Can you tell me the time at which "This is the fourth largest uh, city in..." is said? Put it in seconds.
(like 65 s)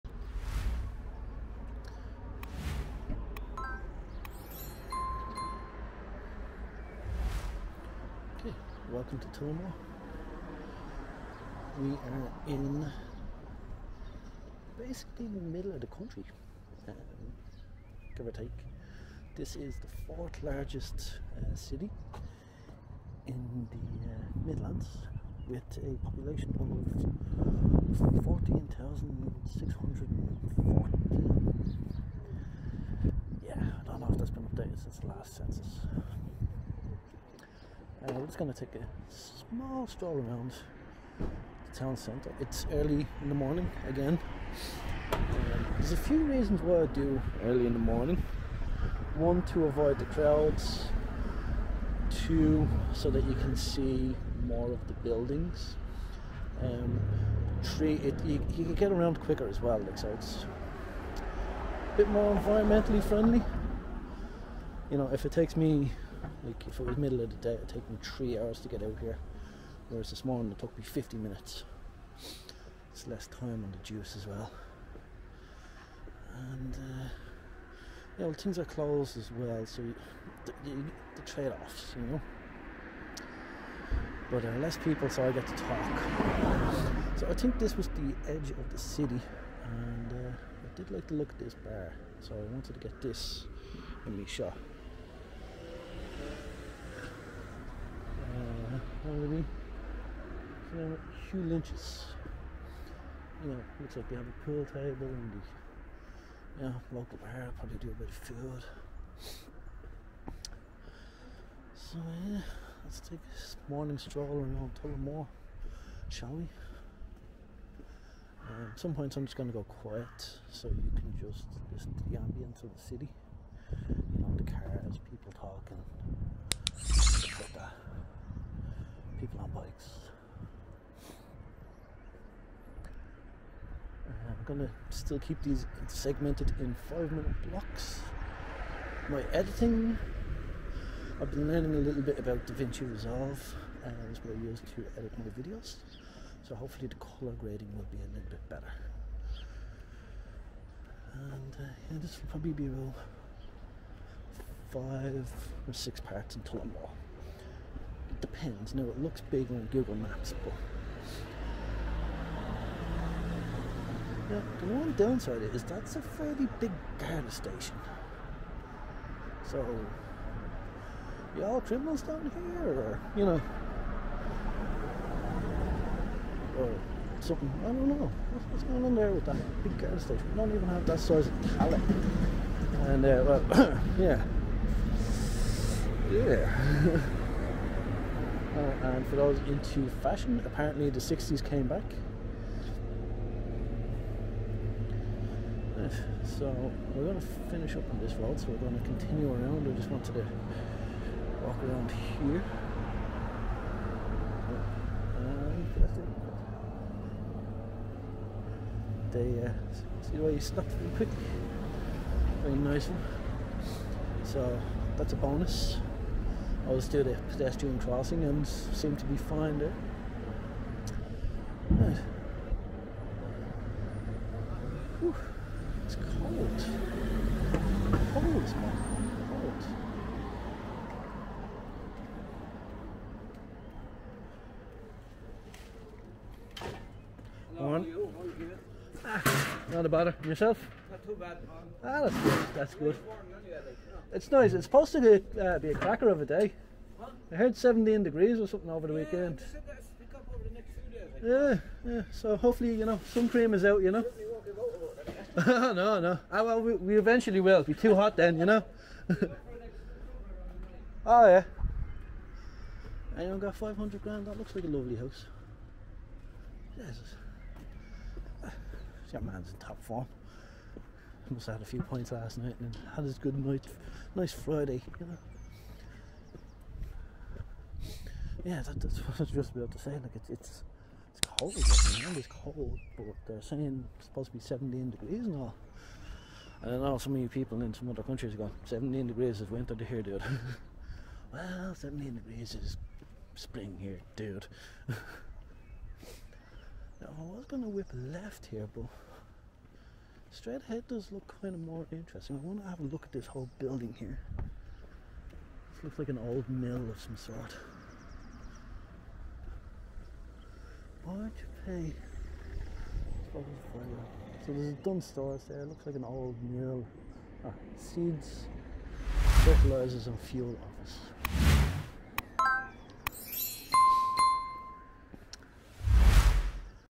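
19 s.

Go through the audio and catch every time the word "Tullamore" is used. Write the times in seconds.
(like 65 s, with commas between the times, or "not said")
9 s, 114 s.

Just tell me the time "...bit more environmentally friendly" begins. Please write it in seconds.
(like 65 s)
61 s.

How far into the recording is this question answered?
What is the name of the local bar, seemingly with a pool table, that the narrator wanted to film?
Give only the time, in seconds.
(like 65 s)
101 s.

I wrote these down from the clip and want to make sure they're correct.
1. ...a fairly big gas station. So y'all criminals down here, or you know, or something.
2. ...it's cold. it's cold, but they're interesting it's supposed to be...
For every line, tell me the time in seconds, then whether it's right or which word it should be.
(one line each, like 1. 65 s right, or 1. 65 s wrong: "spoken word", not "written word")
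1. 165 s right
2. 281 s wrong: "saying", not "interesting".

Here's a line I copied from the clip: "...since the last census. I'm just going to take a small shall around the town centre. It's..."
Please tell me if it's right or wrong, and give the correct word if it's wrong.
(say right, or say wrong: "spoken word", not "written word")
wrong: "stroll", not "shall".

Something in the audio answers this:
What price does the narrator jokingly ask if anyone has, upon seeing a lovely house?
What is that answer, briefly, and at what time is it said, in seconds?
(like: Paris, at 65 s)
500 grand, at 263 s.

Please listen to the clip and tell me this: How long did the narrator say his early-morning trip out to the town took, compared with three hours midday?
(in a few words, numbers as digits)
50 minutes.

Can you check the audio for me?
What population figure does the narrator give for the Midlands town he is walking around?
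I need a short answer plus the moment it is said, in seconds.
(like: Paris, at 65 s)
14,640, at 28 s.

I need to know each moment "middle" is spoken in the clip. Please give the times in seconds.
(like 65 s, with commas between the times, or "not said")
15 s, 66 s.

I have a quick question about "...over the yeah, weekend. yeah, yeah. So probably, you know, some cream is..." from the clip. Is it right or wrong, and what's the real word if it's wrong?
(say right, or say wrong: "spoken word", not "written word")
wrong: "hopefully", not "probably".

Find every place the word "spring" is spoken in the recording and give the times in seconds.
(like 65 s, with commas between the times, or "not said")
293 s.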